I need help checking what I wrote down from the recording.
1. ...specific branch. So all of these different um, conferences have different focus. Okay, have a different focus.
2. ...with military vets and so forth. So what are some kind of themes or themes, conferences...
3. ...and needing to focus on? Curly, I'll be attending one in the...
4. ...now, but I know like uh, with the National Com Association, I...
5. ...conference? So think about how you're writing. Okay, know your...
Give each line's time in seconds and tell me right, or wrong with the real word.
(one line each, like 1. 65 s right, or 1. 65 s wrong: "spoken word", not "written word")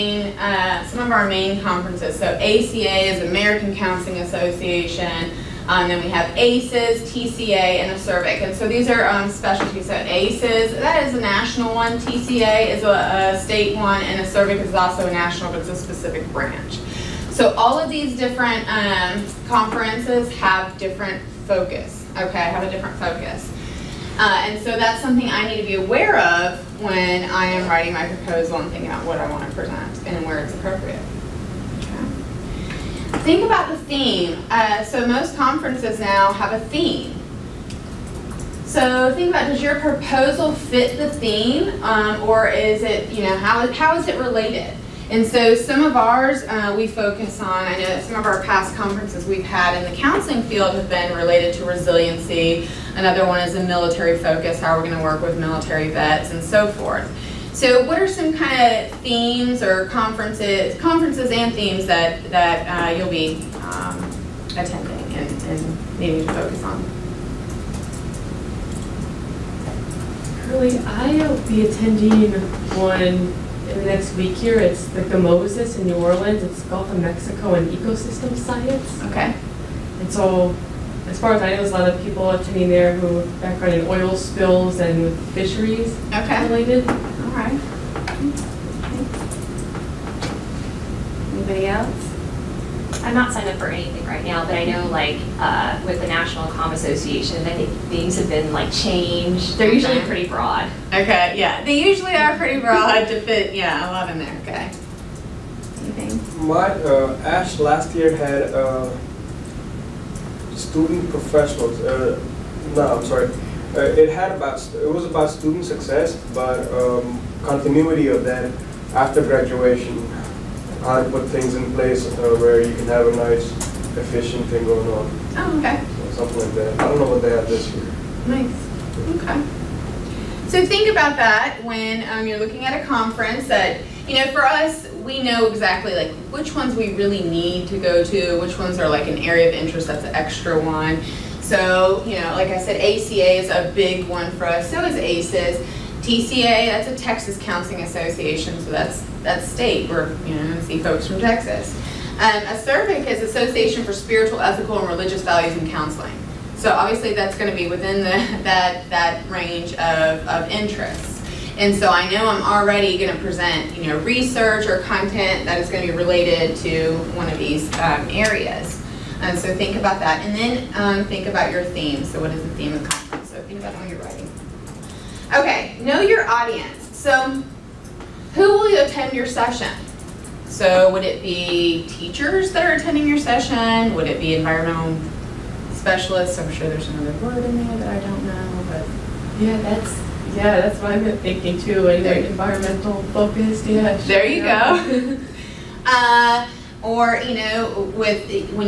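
1. 15 s right
2. 55 s wrong: "conferences", not "themes"
3. 65 s right
4. 94 s right
5. 172 s right.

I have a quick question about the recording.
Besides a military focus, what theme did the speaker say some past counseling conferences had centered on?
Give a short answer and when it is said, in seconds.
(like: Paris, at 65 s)
resiliency, at 51 s.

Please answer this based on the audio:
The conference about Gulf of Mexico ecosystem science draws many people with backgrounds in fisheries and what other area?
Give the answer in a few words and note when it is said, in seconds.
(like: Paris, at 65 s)
oil spills, at 83 s.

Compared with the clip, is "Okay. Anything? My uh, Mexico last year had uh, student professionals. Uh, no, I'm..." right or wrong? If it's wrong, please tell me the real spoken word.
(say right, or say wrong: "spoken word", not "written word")
wrong: "ASHE", not "Mexico".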